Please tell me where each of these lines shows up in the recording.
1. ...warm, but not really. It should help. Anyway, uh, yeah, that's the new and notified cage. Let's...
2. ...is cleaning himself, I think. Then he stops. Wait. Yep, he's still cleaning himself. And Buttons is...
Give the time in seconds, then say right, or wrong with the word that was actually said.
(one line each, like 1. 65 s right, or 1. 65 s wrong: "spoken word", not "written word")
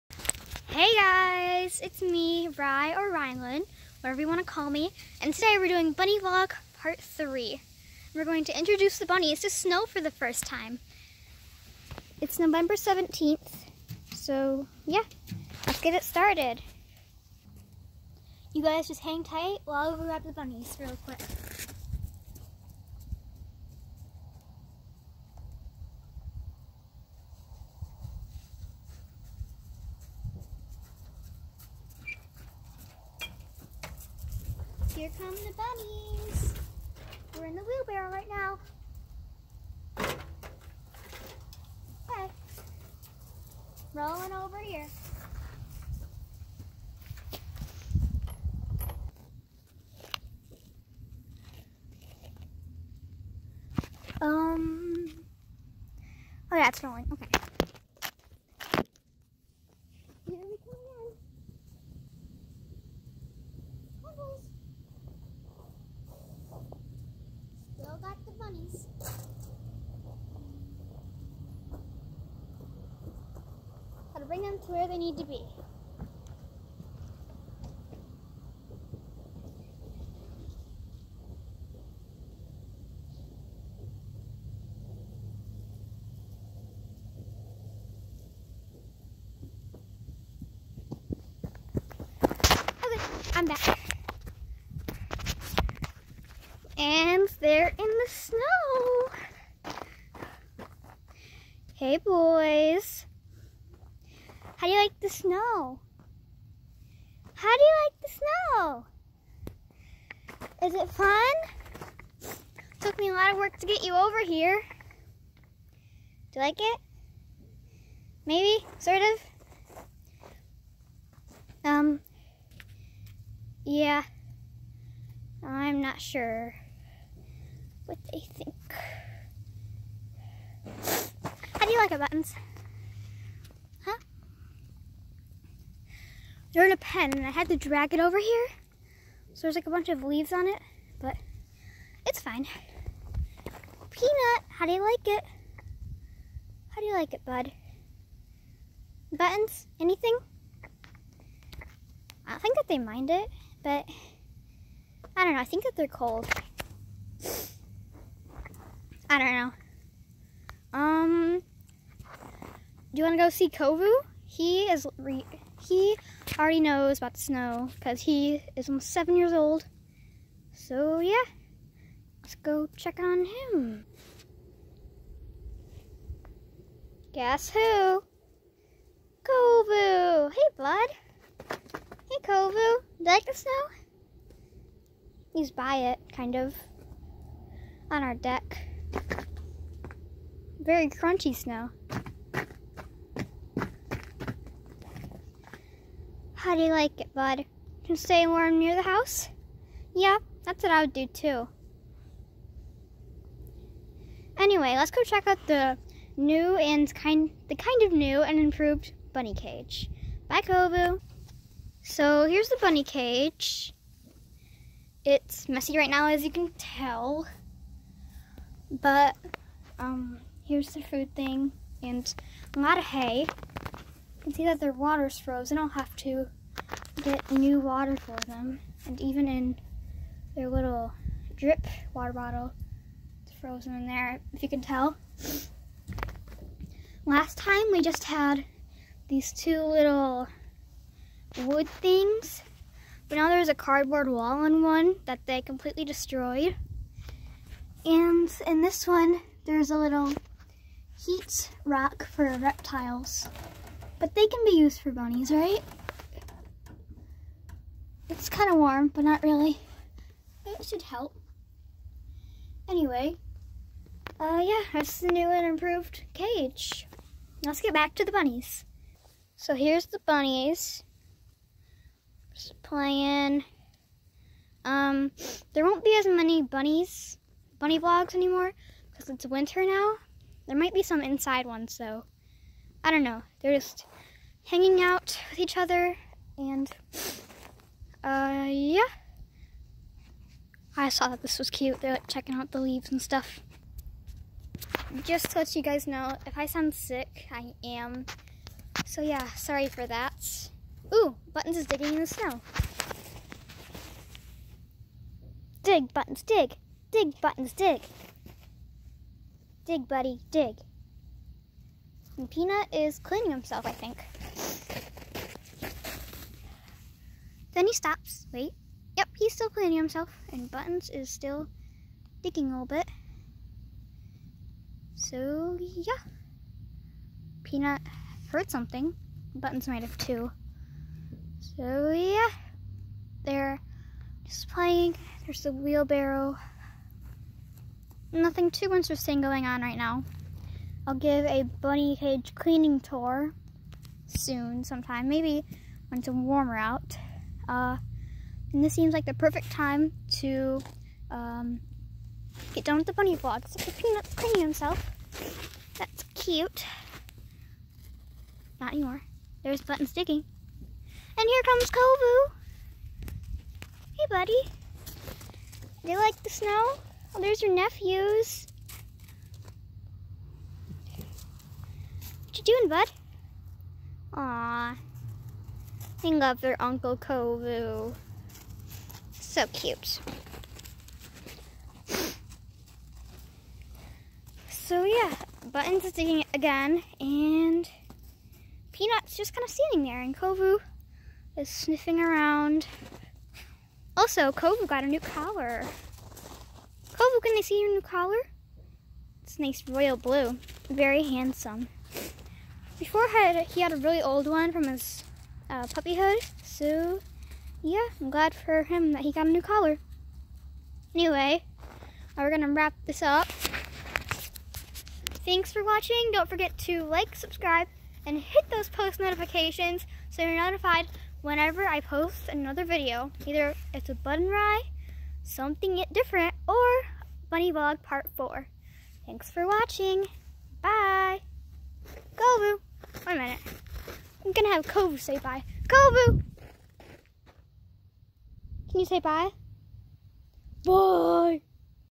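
1. 258 s wrong: "improved", not "notified"
2. 312 s right.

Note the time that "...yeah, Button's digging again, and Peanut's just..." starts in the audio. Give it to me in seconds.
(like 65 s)
384 s.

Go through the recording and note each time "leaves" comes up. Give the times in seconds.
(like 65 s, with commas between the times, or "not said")
140 s, 292 s.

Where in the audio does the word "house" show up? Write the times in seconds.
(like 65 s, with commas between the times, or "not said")
198 s.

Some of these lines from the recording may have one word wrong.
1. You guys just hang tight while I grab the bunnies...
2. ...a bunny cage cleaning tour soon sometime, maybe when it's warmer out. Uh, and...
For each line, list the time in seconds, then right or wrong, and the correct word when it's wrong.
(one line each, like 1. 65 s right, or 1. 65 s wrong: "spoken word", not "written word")
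1. 18 s right
2. 341 s right.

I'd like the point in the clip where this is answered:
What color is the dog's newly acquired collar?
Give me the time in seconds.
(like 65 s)
399 s.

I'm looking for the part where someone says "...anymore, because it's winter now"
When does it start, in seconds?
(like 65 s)
278 s.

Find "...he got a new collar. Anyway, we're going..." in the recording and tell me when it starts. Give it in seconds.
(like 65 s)
409 s.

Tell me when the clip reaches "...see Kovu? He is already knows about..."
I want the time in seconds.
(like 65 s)
163 s.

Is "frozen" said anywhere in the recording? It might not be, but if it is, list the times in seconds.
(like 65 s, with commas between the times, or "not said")
225 s, 233 s.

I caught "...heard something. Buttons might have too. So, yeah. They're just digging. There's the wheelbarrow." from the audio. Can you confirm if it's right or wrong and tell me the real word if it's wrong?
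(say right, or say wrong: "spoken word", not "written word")
wrong: "playing", not "digging".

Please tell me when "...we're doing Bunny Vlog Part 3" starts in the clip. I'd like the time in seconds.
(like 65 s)
5 s.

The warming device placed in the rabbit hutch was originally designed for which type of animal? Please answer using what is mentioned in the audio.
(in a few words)
reptiles.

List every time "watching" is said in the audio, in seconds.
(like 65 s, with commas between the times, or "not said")
415 s, 429 s.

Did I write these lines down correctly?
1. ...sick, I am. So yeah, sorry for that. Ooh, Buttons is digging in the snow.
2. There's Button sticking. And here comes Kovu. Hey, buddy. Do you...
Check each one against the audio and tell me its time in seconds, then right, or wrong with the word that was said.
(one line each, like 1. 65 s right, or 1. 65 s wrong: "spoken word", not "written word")
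1. 296 s right
2. 359 s right.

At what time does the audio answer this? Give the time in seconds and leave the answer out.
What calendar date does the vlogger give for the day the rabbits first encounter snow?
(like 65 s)
12 s.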